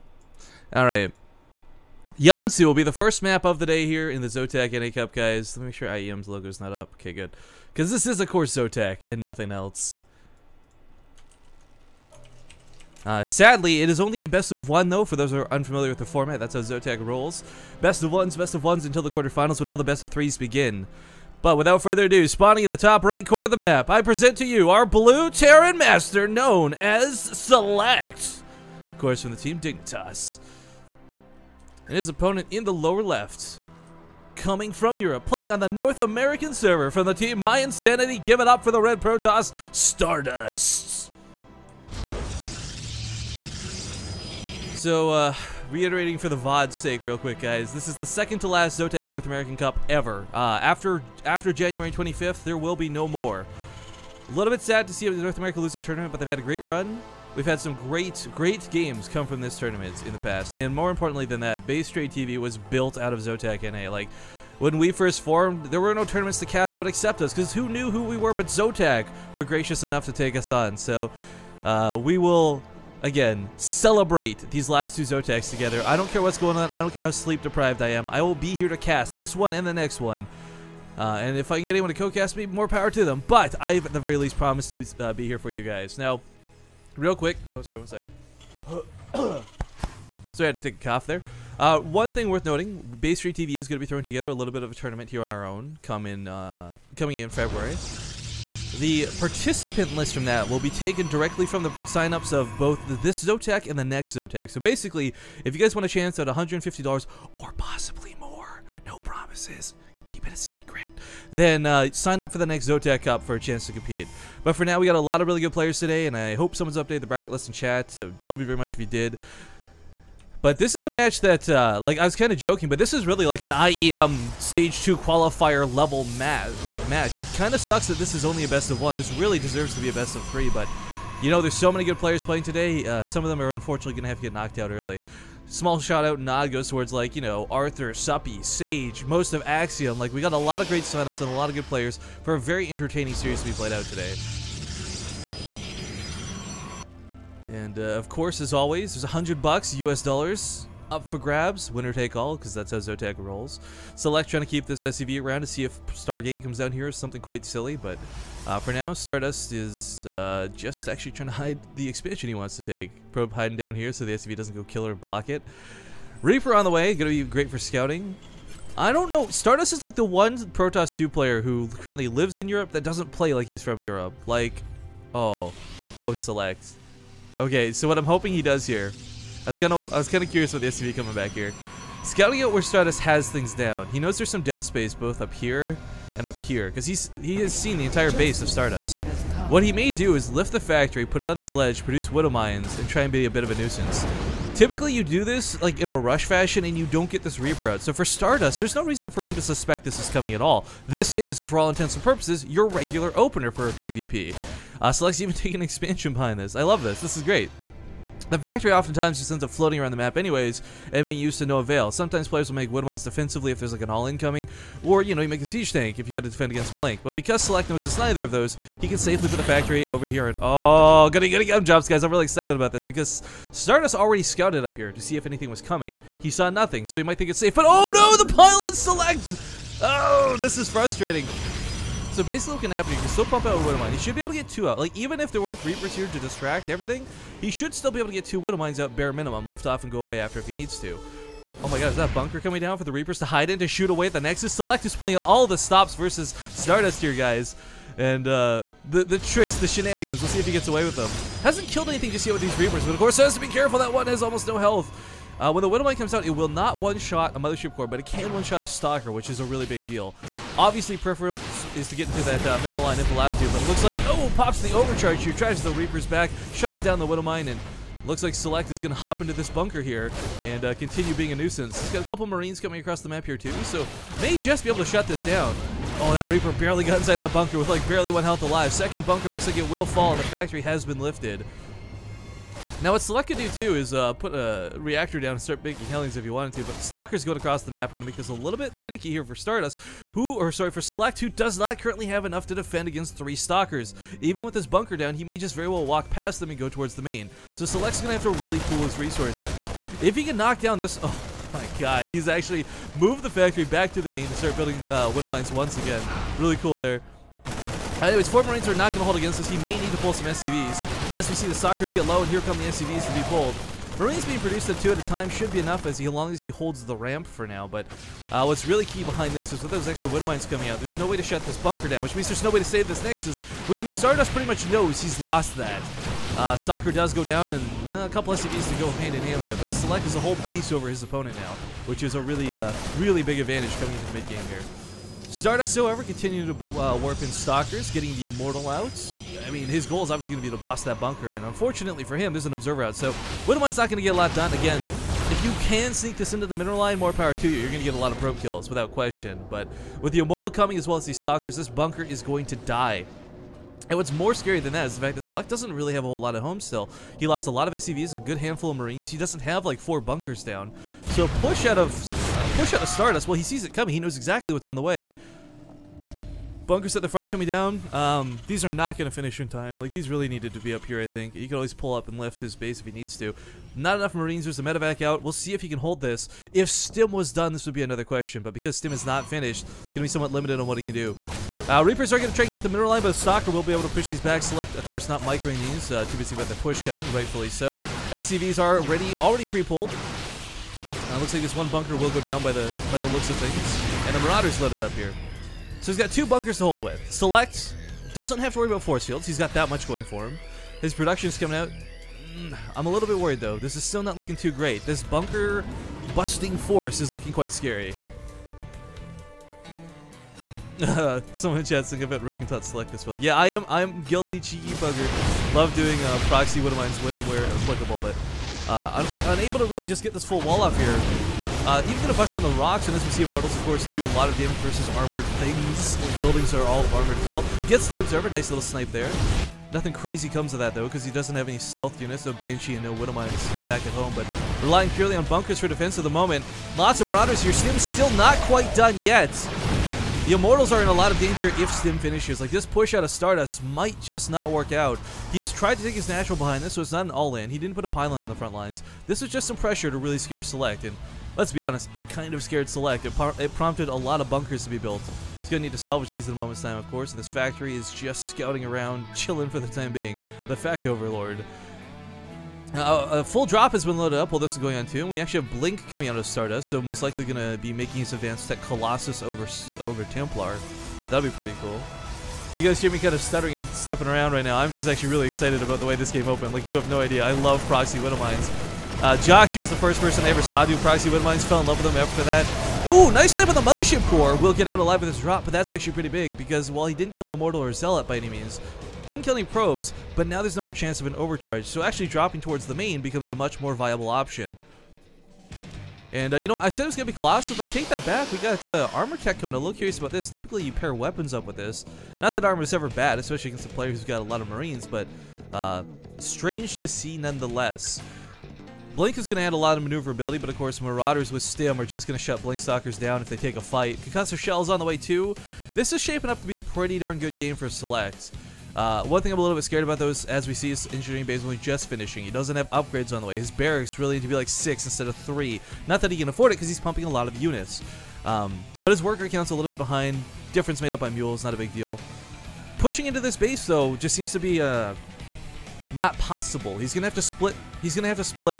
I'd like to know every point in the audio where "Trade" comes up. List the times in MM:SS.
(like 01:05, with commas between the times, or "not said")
01:01, 01:33.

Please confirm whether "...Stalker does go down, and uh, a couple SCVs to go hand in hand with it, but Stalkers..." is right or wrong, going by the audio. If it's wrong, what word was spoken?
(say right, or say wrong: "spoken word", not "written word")
wrong: "Select", not "Stalkers".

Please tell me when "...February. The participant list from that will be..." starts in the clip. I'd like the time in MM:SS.
01:37.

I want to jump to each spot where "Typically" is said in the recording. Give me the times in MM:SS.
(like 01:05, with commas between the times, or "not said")
03:14, 08:20.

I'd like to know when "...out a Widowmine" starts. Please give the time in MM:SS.
03:53.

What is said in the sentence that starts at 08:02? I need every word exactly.
Ooh, nice snipe on the Mothership Core.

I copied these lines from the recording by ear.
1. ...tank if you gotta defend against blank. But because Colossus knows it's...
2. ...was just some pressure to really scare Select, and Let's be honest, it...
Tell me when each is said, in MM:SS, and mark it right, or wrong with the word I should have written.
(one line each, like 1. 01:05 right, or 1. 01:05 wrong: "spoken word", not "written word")
1. 03:35 wrong: "Select", not "Colossus"
2. 07:29 right.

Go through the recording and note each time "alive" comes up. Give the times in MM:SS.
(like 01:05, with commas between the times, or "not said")
04:38, 08:04.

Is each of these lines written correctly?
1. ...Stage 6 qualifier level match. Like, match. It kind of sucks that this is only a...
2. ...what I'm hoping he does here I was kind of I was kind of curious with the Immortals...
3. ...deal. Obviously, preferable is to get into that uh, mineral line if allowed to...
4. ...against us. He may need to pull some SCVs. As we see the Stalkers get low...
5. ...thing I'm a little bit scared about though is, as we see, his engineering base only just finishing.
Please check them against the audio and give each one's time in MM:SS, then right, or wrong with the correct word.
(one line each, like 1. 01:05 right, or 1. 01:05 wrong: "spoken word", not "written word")
1. 02:04 wrong: "2", not "6"
2. 02:57 wrong: "SCV", not "Immortals"
3. 04:19 right
4. 05:09 right
5. 08:39 right.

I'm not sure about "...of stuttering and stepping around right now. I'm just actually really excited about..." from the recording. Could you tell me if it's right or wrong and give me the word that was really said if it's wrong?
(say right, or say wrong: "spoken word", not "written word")
right.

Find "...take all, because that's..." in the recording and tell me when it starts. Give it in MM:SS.
02:31.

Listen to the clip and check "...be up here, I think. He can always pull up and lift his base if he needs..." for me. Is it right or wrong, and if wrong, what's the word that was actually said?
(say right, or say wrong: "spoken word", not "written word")
right.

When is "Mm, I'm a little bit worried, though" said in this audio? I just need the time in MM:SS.
06:42.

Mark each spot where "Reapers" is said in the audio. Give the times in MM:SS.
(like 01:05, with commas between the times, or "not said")
02:46, 03:17, 03:55, 04:02, 04:12, 04:25, 04:36, 06:21.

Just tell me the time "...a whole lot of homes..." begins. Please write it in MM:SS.
05:56.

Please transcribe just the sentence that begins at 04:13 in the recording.
That one has almost no health.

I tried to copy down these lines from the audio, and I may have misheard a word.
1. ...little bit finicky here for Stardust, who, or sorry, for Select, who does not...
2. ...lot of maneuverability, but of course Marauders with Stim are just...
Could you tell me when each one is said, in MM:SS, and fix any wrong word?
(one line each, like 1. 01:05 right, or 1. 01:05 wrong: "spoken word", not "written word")
1. 04:48 right
2. 08:29 right.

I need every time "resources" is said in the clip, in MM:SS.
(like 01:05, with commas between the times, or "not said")
04:58.